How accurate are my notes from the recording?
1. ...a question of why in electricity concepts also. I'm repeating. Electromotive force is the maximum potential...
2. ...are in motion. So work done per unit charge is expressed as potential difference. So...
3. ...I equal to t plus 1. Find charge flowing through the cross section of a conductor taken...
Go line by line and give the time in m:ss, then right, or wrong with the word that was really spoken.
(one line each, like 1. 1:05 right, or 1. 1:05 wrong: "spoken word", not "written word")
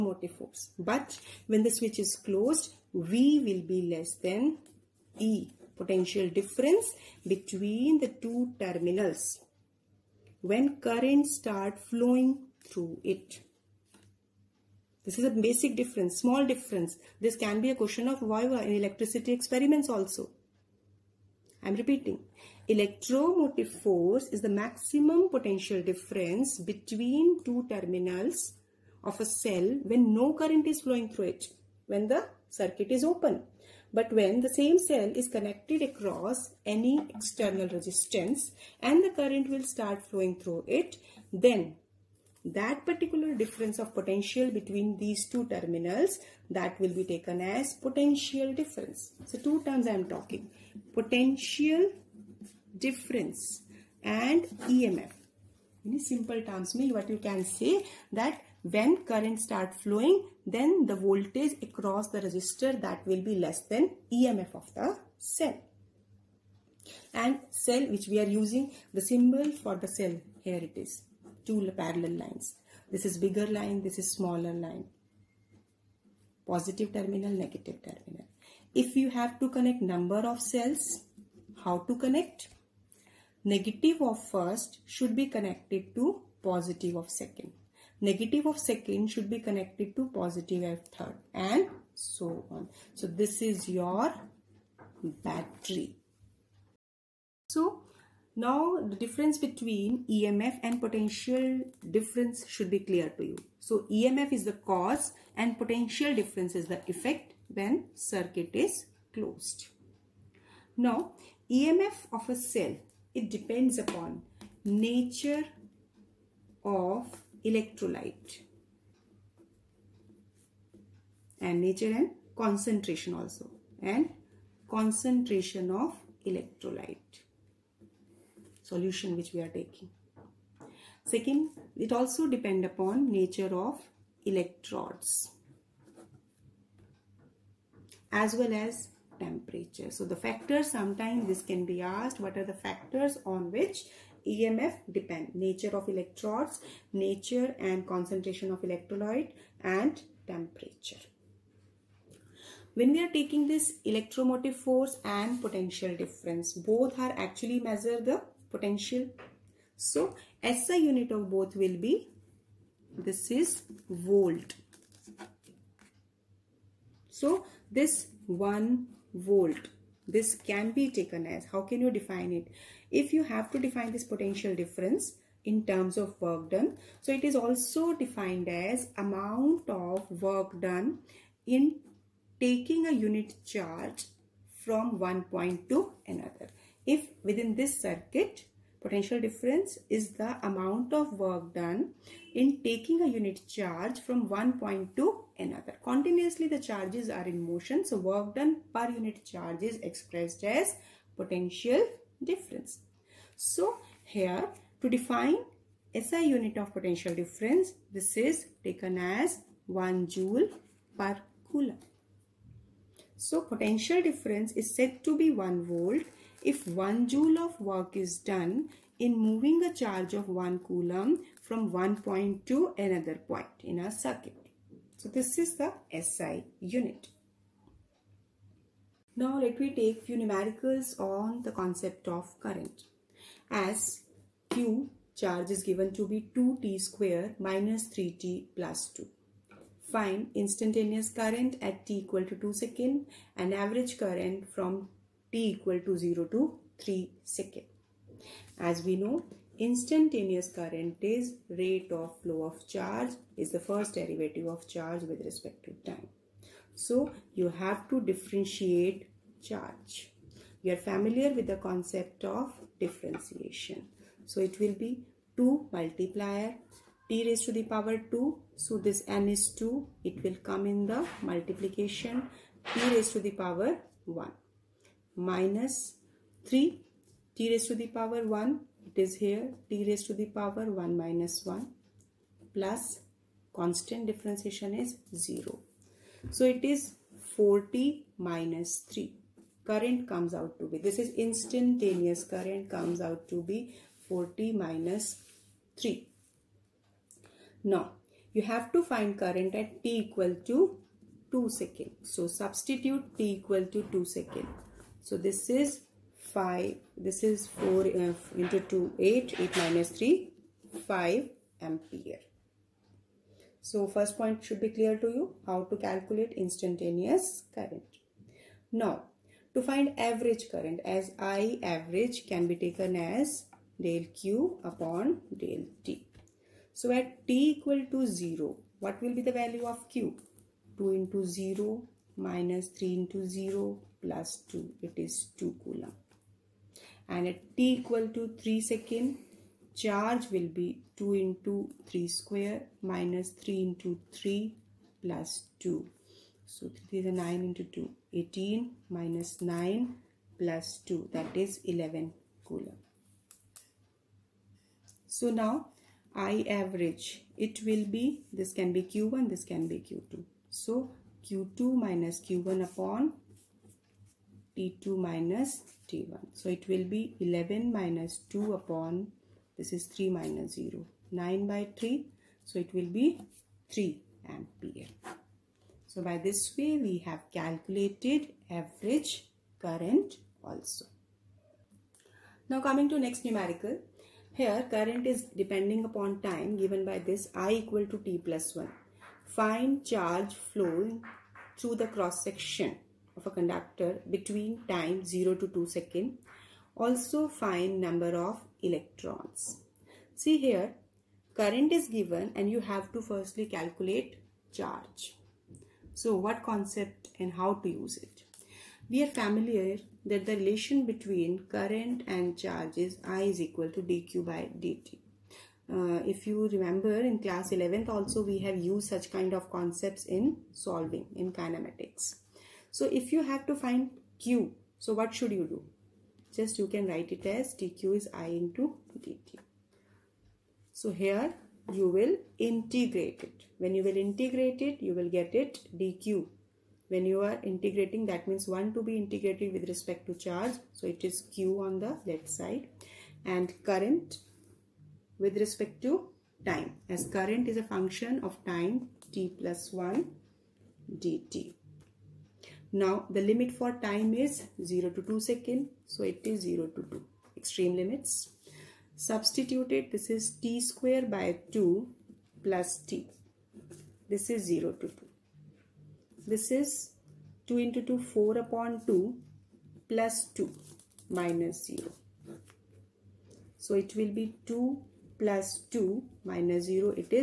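1. 0:17 wrong: "experiments", not "concepts"
2. 3:17 right
3. 6:27 wrong: "between", not "taken".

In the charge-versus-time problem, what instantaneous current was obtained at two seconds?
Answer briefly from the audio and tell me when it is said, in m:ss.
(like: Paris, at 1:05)
5 ampere, at 5:10.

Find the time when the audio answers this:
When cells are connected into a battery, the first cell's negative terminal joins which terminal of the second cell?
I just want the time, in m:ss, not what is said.
1:26.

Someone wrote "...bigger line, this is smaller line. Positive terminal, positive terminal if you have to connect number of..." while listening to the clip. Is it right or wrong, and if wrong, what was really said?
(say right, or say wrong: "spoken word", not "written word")
wrong: "negative", not "positive".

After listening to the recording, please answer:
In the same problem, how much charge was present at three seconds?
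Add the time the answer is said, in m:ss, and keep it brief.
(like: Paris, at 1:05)
11 coulomb, at 5:51.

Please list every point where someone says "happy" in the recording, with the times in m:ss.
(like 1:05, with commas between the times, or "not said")
not said.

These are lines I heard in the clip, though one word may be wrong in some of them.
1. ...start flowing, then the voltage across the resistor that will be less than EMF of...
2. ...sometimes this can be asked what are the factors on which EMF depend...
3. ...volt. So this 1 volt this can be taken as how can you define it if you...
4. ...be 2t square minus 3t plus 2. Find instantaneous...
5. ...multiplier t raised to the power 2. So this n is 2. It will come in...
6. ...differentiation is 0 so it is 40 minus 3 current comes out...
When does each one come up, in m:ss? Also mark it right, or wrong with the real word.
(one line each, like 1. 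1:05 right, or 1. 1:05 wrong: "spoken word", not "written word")
1. 0:59 right
2. 2:20 right
3. 2:43 right
4. 3:56 right
5. 4:25 right
6. 4:44 right.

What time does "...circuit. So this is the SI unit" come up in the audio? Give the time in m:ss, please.
3:43.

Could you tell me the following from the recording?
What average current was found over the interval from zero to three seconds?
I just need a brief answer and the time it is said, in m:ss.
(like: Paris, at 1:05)
3 ampere, at 6:13.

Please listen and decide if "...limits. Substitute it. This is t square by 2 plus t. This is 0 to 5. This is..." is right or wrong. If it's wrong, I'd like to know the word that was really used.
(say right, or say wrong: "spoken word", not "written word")
wrong: "2", not "5".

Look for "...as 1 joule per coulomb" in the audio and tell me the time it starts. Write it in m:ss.
3:28.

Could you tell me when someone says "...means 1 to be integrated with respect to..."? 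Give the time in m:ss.
7:18.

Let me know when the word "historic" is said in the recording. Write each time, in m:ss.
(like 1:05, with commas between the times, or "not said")
not said.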